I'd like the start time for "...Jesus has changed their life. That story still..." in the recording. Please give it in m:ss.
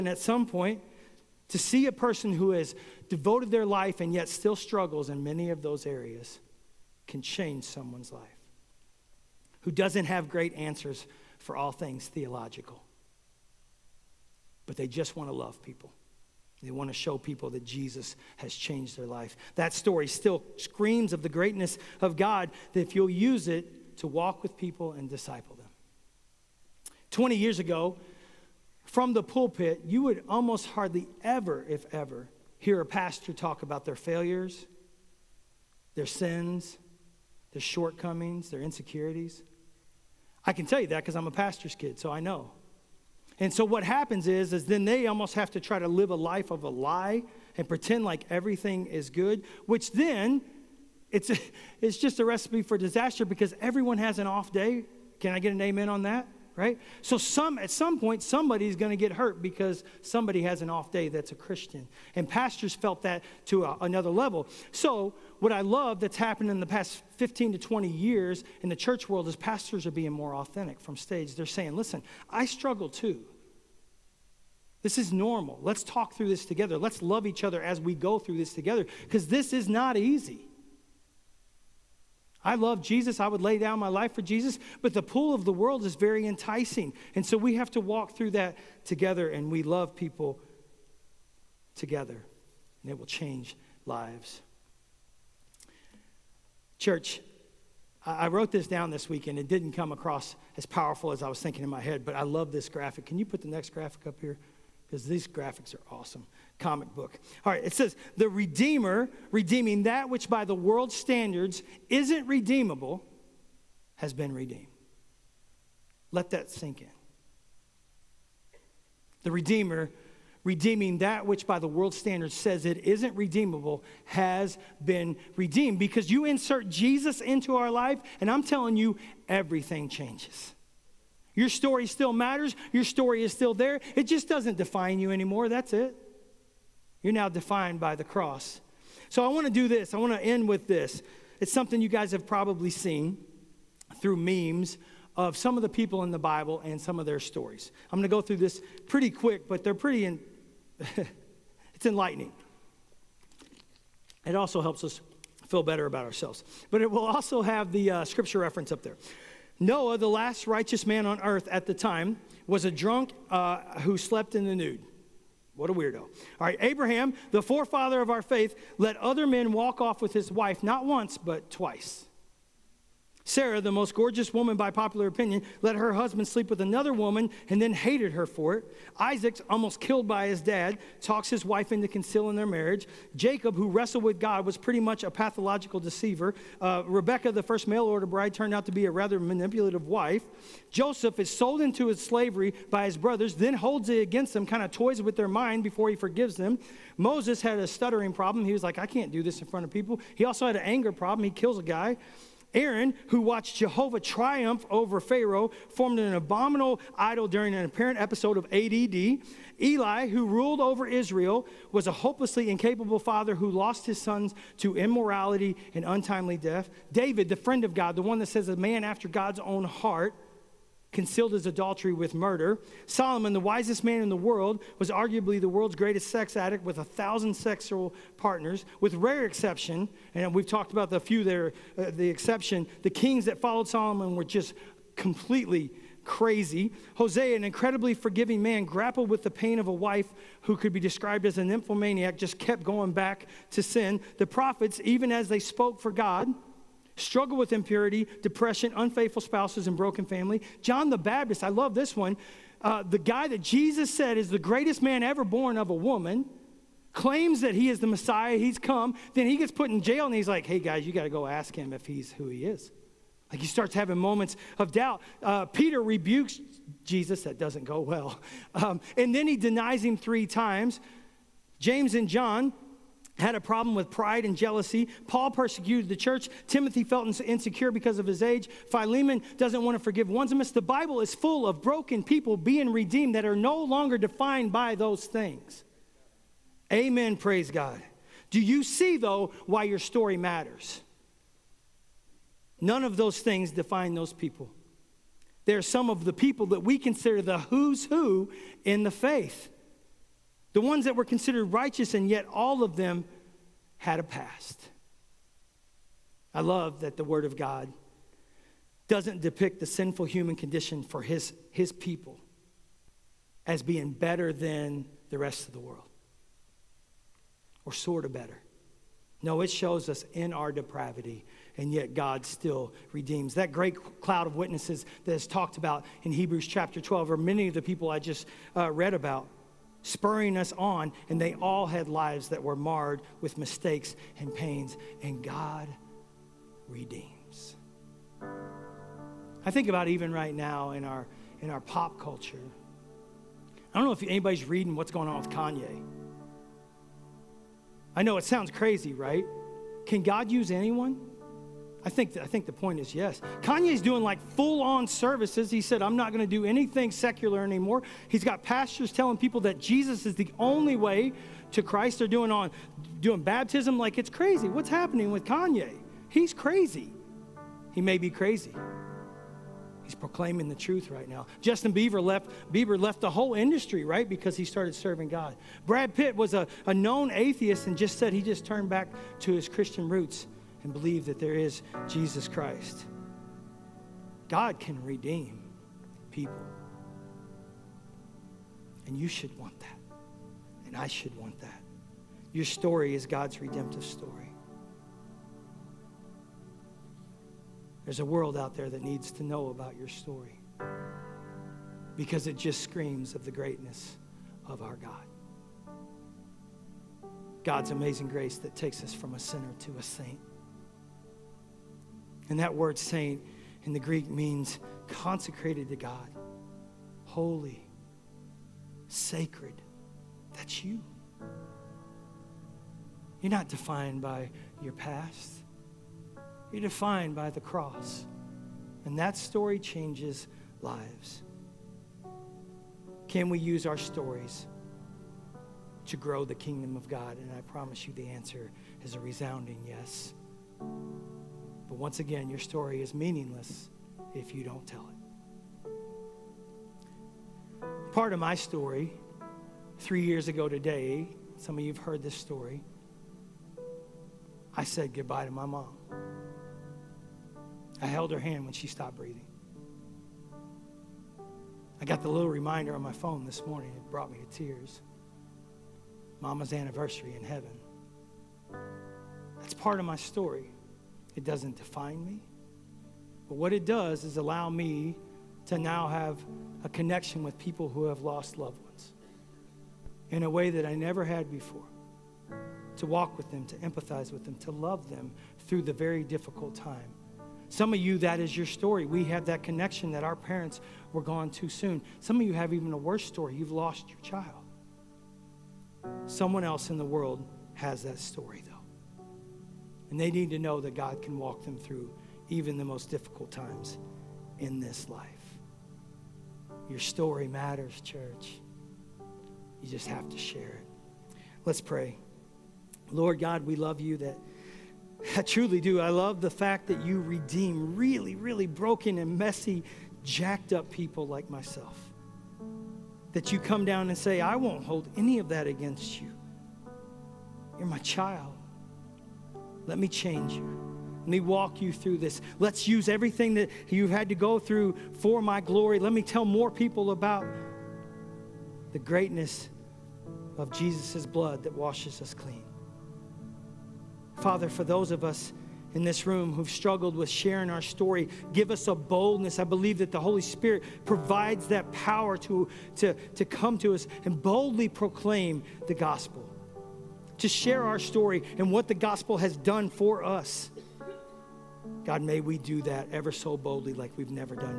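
0:17.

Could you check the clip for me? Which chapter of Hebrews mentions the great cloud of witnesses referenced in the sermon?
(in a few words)
Chapter 12.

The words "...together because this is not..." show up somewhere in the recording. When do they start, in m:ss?
1:18.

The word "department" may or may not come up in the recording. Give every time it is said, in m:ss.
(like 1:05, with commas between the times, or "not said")
not said.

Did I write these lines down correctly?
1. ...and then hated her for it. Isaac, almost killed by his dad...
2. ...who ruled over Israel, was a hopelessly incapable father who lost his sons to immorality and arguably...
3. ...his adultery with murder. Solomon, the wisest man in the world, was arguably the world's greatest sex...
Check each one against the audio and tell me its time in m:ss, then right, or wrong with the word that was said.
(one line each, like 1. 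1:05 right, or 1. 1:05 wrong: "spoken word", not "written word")
1. 2:57 right
2. 3:30 wrong: "untimely", not "arguably"
3. 3:41 right.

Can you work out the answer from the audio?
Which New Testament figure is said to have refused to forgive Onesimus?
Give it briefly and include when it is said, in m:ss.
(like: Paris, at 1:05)
Philemon, at 4:38.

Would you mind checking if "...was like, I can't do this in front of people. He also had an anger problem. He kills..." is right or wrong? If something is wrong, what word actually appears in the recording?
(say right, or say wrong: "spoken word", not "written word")
right.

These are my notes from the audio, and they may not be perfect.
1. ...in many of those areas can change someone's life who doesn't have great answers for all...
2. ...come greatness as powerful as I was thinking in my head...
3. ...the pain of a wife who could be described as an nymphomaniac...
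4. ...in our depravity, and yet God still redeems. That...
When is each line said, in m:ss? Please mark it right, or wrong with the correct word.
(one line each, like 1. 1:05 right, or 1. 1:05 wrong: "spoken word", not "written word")
1. 0:05 right
2. 1:39 wrong: "across", not "greatness"
3. 3:59 right
4. 5:20 right.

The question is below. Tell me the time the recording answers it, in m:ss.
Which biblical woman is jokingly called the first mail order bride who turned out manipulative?
3:06.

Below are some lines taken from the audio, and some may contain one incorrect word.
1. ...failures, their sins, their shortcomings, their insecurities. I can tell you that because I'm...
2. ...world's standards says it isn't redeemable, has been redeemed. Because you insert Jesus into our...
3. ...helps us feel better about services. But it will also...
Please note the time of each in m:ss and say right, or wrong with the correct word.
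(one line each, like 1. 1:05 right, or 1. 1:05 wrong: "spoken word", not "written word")
1. 0:33 right
2. 2:01 right
3. 2:34 wrong: "ourselves", not "services".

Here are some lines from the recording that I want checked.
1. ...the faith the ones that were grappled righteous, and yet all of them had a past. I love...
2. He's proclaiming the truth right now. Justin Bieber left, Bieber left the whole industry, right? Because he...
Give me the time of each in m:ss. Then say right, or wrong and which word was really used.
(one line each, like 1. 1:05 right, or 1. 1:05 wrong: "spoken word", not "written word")
1. 4:58 wrong: "considered", not "grappled"
2. 6:09 right.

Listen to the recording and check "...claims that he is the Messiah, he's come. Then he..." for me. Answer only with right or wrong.
right.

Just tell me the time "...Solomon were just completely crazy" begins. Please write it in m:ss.
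3:53.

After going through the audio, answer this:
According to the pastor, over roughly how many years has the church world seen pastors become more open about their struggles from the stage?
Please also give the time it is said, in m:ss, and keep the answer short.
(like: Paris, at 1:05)
15 to 20 years, at 1:07.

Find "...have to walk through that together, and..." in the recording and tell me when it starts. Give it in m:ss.
1:27.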